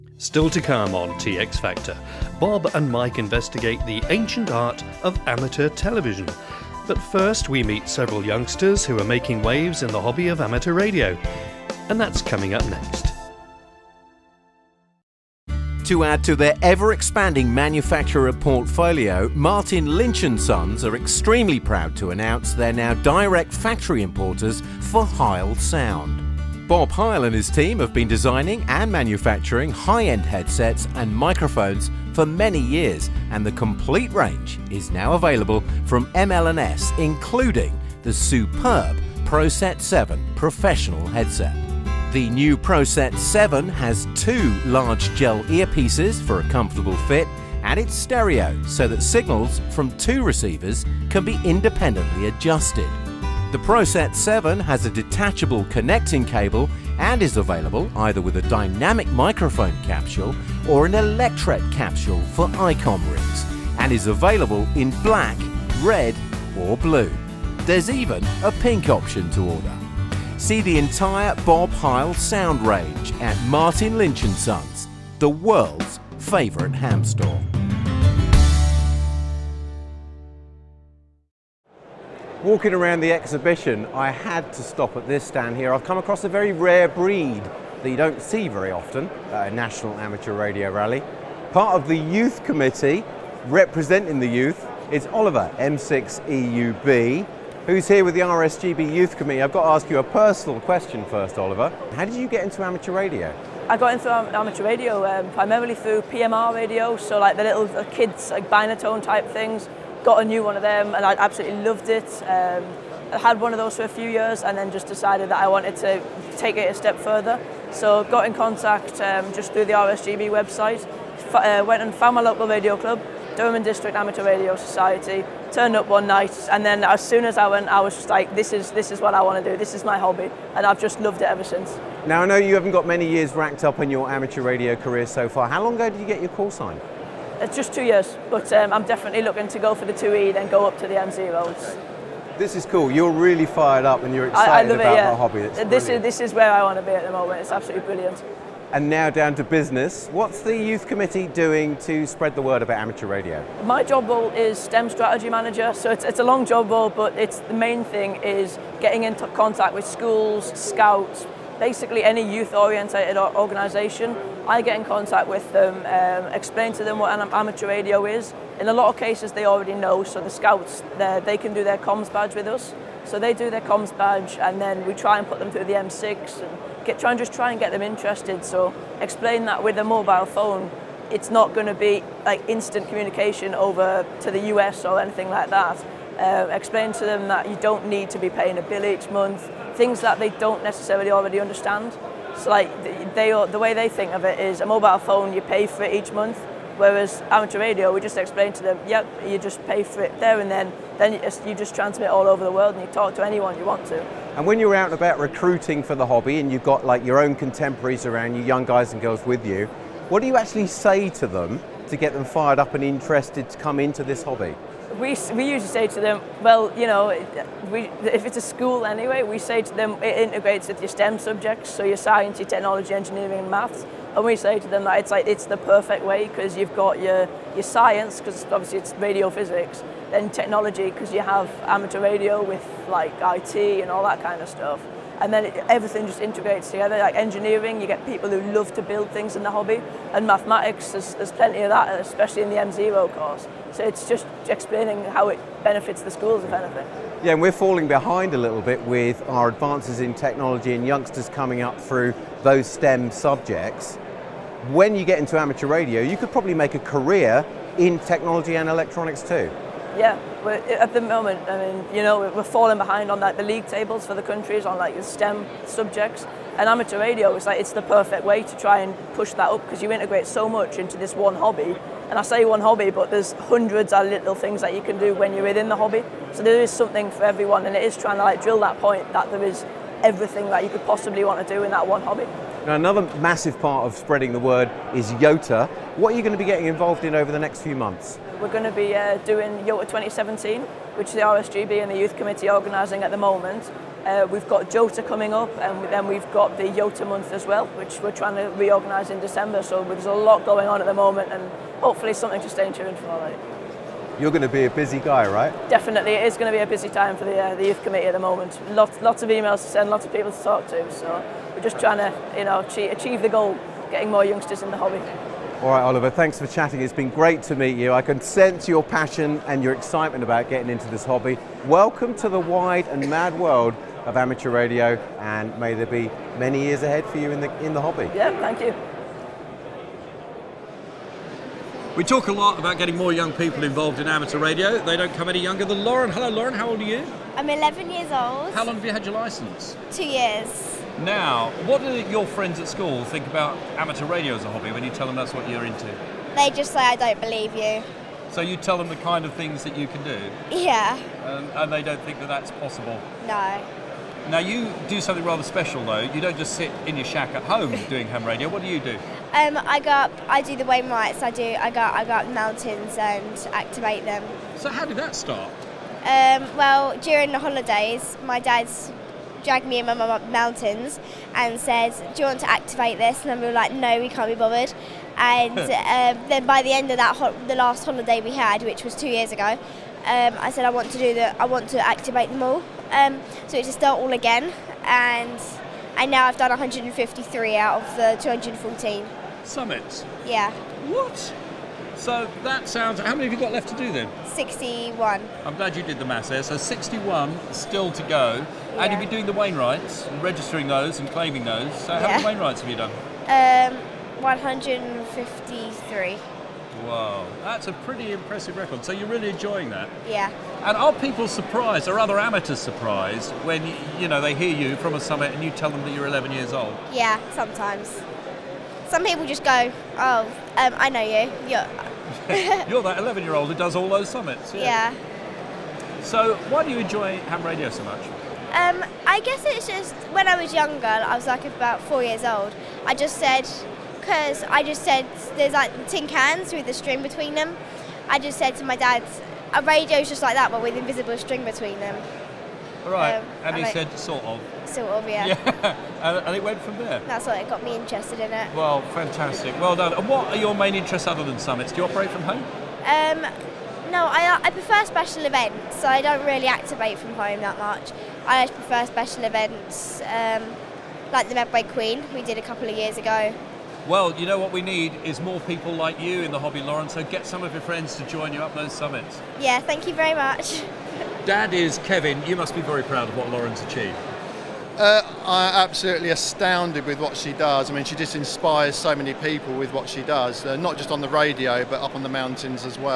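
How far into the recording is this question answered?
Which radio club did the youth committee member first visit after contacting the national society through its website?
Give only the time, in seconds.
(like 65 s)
123 s.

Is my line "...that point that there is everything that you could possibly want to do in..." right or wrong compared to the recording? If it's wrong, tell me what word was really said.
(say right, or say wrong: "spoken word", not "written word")
right.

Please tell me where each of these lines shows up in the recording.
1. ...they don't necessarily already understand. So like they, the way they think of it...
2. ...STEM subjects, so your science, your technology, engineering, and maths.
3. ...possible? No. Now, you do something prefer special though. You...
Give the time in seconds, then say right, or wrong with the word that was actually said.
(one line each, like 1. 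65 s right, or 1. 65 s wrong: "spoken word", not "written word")
1. 190 s right
2. 220 s right
3. 352 s wrong: "rather", not "prefer".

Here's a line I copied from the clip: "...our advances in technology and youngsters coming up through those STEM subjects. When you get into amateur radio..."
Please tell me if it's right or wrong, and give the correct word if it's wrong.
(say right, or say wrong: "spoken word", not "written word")
right.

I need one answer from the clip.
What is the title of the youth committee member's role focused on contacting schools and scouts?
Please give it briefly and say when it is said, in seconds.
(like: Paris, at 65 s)
STEM strategy manager, at 154 s.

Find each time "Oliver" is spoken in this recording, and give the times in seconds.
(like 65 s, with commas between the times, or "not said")
95 s, 101 s, 315 s.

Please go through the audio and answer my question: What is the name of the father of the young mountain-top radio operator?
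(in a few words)
Kevin.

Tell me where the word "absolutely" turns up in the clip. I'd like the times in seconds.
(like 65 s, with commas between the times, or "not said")
111 s, 147 s, 475 s.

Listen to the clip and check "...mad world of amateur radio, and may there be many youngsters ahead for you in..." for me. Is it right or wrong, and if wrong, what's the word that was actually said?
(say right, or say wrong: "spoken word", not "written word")
wrong: "years", not "youngsters".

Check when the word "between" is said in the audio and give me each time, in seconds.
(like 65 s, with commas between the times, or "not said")
437 s, 441 s.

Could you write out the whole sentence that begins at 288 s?
we're going to be uh, doing YOTA 2017, which the RSGB and the Youth Committee are organising at the moment.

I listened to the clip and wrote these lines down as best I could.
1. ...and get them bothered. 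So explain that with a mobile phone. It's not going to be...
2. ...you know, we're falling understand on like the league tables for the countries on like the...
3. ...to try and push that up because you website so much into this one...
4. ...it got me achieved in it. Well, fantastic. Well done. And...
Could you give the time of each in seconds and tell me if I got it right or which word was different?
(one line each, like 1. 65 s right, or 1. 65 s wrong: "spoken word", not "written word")
1. 177 s wrong: "interested", not "bothered"
2. 261 s wrong: "behind", not "understand"
3. 268 s wrong: "integrate", not "website"
4. 447 s wrong: "interested", not "achieved".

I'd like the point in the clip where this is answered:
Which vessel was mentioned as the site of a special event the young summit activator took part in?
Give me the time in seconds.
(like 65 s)
461 s.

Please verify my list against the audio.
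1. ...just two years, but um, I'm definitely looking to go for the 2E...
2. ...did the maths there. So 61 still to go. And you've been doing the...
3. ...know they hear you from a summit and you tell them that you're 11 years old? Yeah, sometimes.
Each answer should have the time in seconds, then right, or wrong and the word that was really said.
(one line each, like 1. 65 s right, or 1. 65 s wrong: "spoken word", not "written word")
1. 137 s right
2. 395 s right
3. 414 s right.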